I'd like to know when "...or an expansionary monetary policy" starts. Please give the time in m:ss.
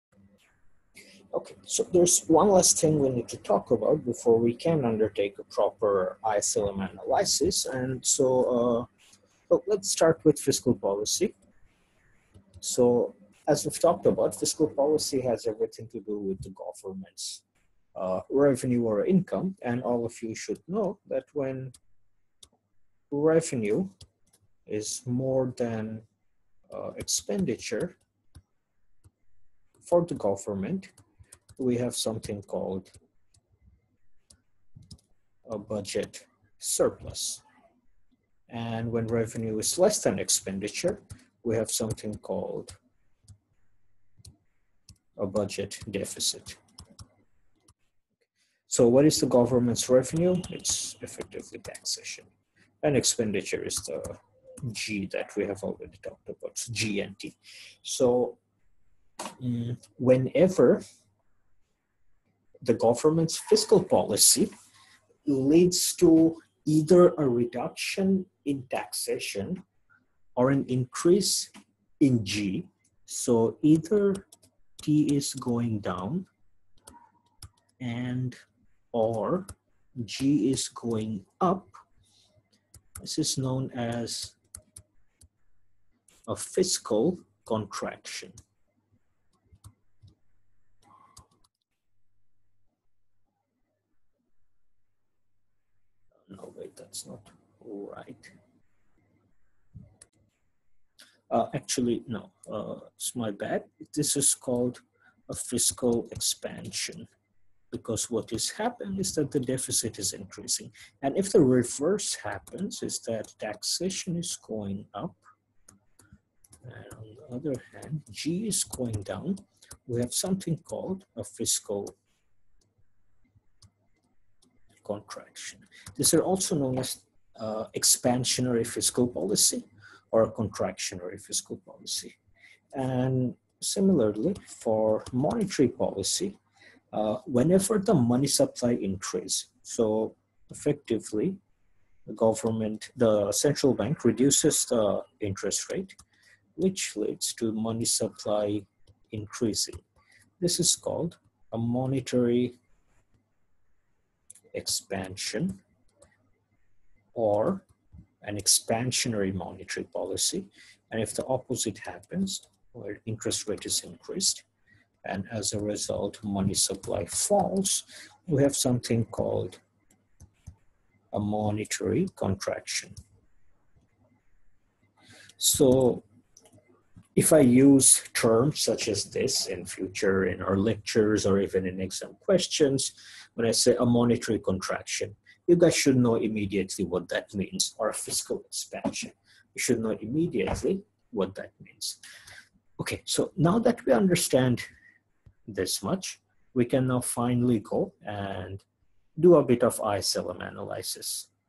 2:37.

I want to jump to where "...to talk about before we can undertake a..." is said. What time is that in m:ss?
0:03.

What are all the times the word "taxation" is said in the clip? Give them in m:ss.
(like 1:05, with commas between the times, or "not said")
0:51, 1:08, 1:53.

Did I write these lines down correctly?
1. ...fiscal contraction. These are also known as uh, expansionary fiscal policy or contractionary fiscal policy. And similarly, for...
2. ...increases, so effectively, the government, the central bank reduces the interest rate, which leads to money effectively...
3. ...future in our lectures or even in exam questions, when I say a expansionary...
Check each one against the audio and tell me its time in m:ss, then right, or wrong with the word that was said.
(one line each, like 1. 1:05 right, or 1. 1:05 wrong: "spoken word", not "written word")
1. 2:01 right
2. 2:18 wrong: "supply", not "effectively"
3. 2:59 wrong: "monetary", not "expansionary".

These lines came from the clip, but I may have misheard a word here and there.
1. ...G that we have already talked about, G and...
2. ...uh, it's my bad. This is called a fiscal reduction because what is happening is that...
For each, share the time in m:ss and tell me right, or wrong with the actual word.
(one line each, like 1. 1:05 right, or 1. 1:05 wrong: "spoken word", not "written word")
1. 0:54 right
2. 1:42 wrong: "expansion", not "reduction".